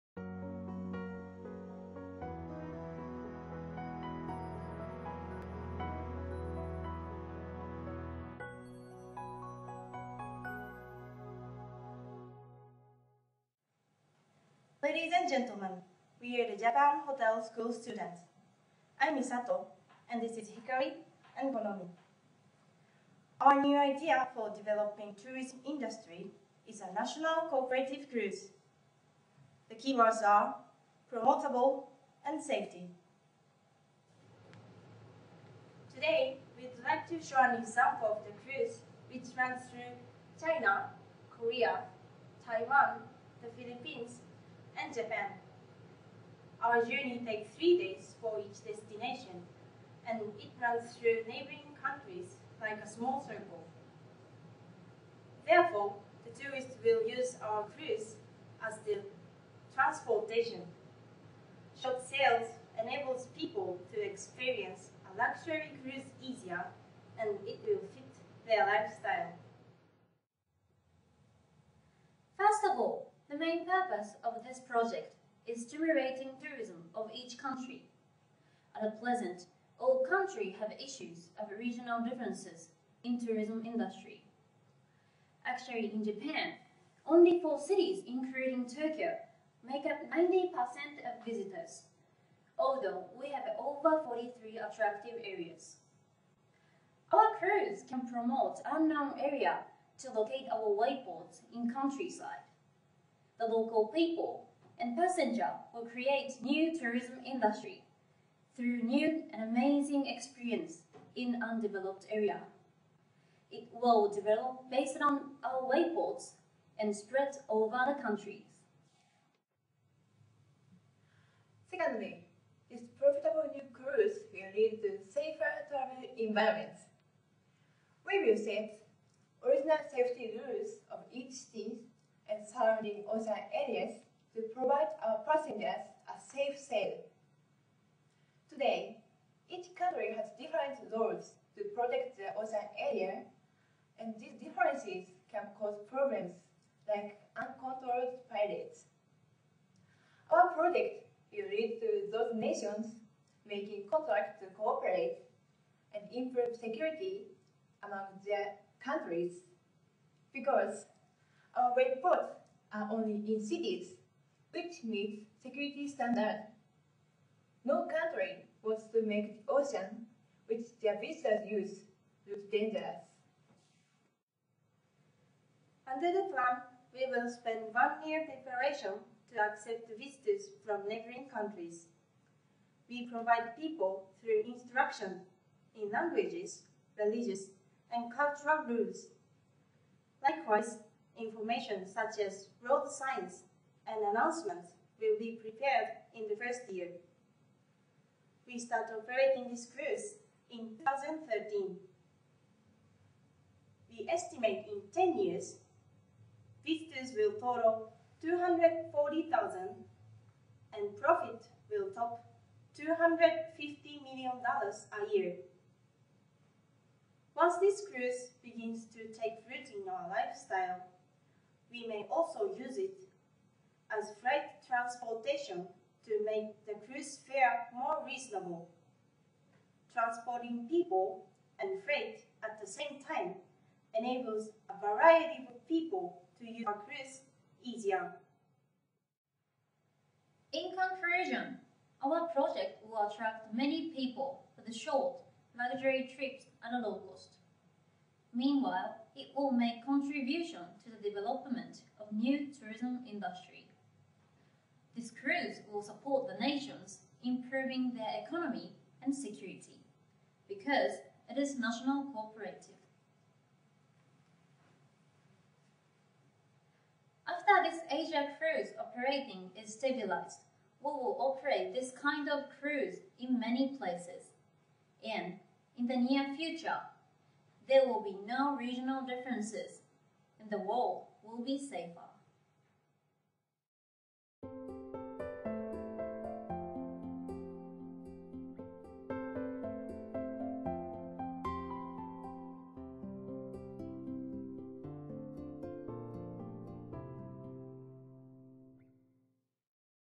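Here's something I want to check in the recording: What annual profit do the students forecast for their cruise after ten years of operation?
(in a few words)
$250 million.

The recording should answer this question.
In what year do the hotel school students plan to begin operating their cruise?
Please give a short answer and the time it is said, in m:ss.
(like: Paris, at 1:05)
2013, at 3:20.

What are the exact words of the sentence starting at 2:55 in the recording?
Under the plan, we will spend one year preparation to accept visitors from neighboring countries.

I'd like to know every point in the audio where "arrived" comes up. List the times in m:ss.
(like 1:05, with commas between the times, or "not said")
not said.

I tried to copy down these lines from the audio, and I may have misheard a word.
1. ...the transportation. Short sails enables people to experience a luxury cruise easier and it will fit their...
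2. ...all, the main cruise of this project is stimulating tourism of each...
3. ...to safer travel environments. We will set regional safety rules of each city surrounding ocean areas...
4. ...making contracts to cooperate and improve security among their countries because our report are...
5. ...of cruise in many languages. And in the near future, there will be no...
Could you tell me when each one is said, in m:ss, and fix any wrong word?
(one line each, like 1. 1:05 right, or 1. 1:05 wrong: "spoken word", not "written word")
1. 0:58 right
2. 1:12 wrong: "purpose", not "cruise"
3. 2:04 wrong: "original", not "regional"
4. 2:33 right
5. 4:32 wrong: "places", not "languages".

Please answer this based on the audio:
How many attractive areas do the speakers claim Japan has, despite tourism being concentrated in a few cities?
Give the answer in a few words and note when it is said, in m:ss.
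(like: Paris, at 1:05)
Over 43, at 1:33.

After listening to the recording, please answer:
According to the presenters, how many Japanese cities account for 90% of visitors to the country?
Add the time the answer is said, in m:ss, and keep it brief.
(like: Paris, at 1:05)
4, at 1:27.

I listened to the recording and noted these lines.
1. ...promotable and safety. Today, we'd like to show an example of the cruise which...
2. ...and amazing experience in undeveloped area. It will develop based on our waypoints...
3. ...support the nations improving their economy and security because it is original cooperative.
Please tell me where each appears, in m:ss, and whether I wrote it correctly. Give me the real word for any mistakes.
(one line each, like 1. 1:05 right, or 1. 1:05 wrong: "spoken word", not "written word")
1. 0:31 right
2. 1:49 right
3. 4:15 wrong: "national", not "original".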